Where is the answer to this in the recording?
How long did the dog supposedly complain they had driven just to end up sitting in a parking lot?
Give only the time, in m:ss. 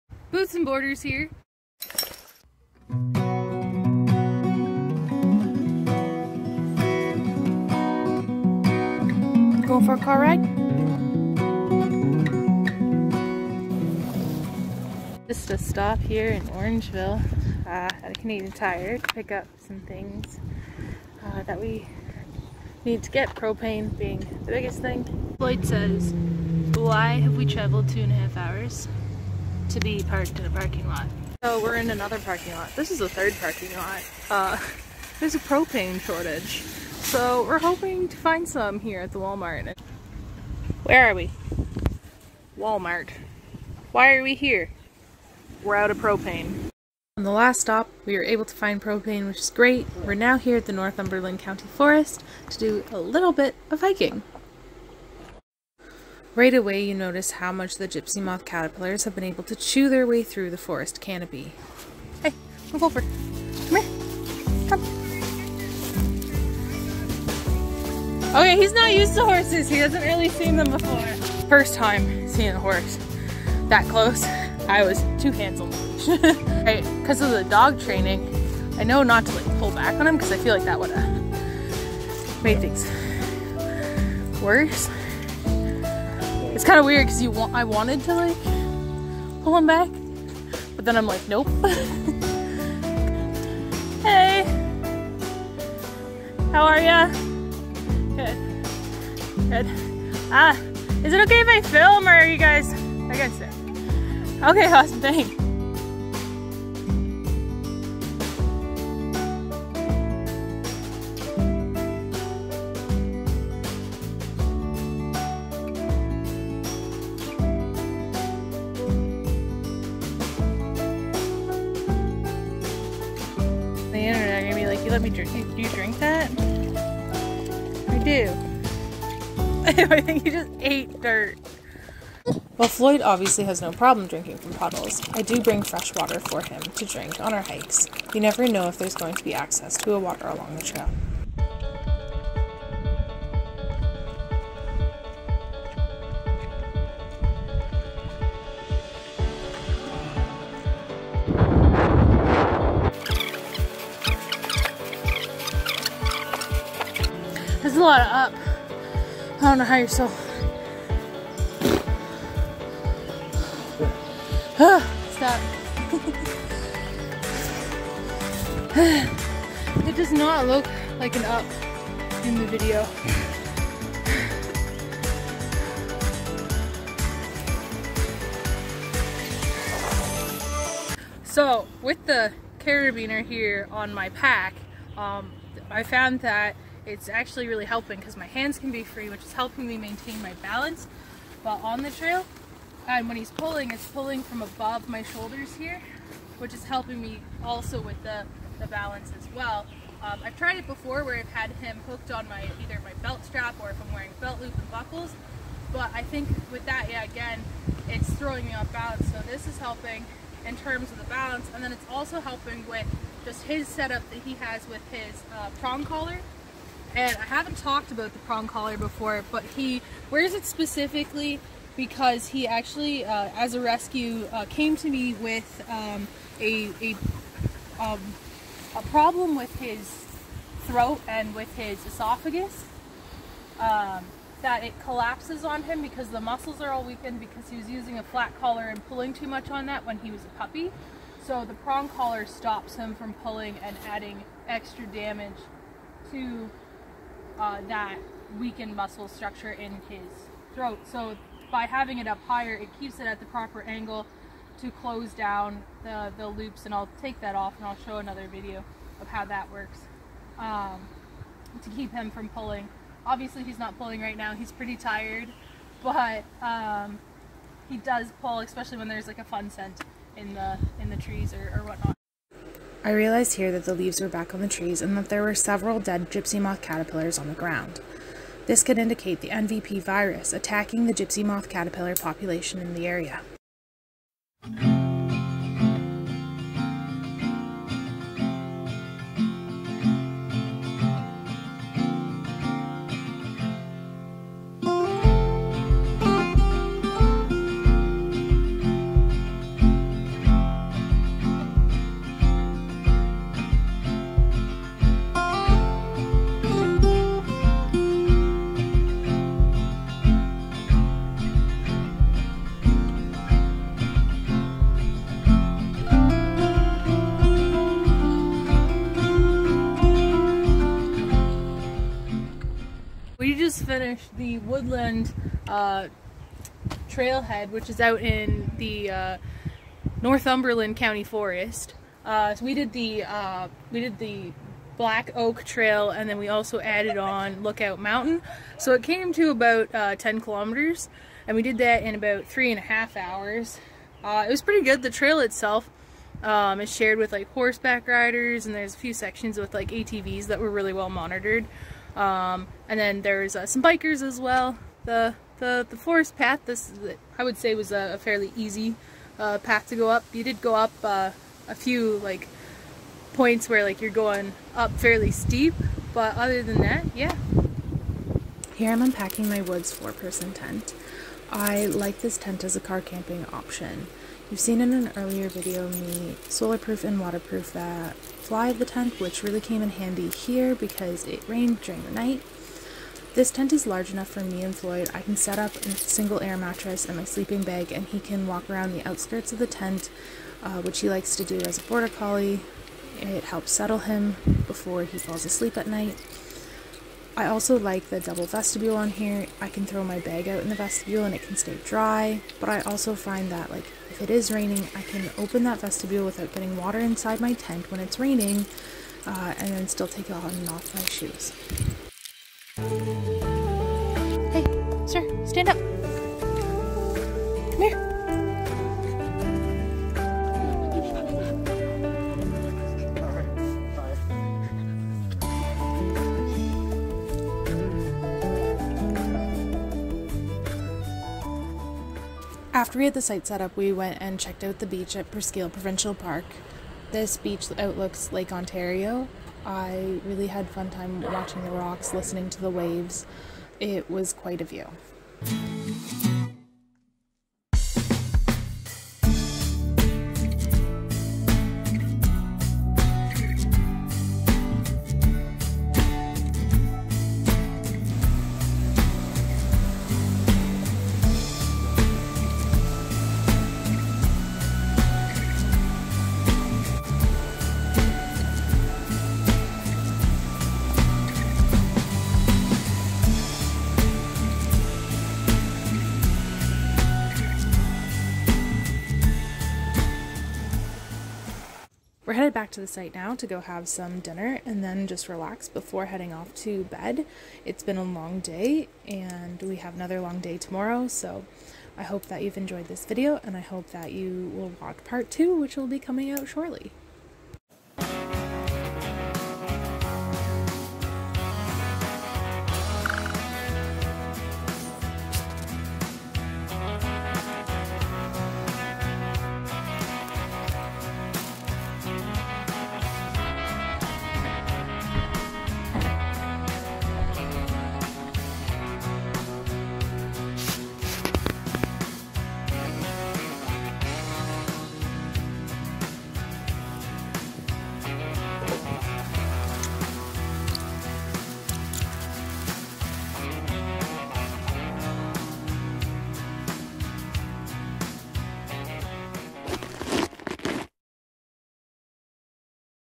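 0:27.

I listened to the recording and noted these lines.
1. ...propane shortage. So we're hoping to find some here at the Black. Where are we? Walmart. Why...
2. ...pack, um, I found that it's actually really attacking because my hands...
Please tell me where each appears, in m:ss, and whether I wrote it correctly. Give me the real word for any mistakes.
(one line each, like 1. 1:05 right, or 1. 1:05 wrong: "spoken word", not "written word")
1. 0:35 wrong: "Walmart", not "Black"
2. 3:04 wrong: "helping", not "attacking".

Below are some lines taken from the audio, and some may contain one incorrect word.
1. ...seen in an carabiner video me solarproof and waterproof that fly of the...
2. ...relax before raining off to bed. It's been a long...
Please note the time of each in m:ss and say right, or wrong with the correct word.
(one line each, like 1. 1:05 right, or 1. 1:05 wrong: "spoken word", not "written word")
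1. 6:14 wrong: "earlier", not "carabiner"
2. 8:05 wrong: "heading", not "raining".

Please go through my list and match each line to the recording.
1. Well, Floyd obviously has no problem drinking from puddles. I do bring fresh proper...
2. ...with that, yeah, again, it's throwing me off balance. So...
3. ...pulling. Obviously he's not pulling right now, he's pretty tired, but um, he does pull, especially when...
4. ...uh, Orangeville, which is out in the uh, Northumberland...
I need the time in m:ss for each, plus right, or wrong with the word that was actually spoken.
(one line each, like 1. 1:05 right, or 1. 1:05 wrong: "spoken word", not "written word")
1. 2:12 wrong: "water", not "proper"
2. 3:26 right
3. 4:22 right
4. 5:25 wrong: "Trailhead", not "Orangeville".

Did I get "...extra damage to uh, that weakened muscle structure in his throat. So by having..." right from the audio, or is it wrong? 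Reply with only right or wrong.
right.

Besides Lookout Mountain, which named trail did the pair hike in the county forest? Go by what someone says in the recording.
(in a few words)
Black Oak Trail.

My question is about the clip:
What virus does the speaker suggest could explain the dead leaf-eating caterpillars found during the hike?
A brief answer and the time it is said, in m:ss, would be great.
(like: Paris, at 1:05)
NVP virus, at 4:39.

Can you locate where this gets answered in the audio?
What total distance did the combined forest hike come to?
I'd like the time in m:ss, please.
5:39.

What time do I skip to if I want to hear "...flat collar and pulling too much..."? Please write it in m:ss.
3:58.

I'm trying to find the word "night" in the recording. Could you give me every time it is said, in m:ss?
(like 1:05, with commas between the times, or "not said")
6:21, 6:35.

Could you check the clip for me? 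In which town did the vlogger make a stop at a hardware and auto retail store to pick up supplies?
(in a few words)
Orangeville.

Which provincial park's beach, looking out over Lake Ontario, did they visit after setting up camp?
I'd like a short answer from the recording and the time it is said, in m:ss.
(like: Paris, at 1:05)
Presqu'île Provincial Park, at 7:15.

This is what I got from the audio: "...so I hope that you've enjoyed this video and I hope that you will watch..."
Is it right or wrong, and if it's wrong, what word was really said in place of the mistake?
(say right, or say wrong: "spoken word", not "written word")
right.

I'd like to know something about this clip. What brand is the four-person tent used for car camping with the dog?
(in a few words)
Woods.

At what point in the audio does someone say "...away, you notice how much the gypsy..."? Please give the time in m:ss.
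0:56.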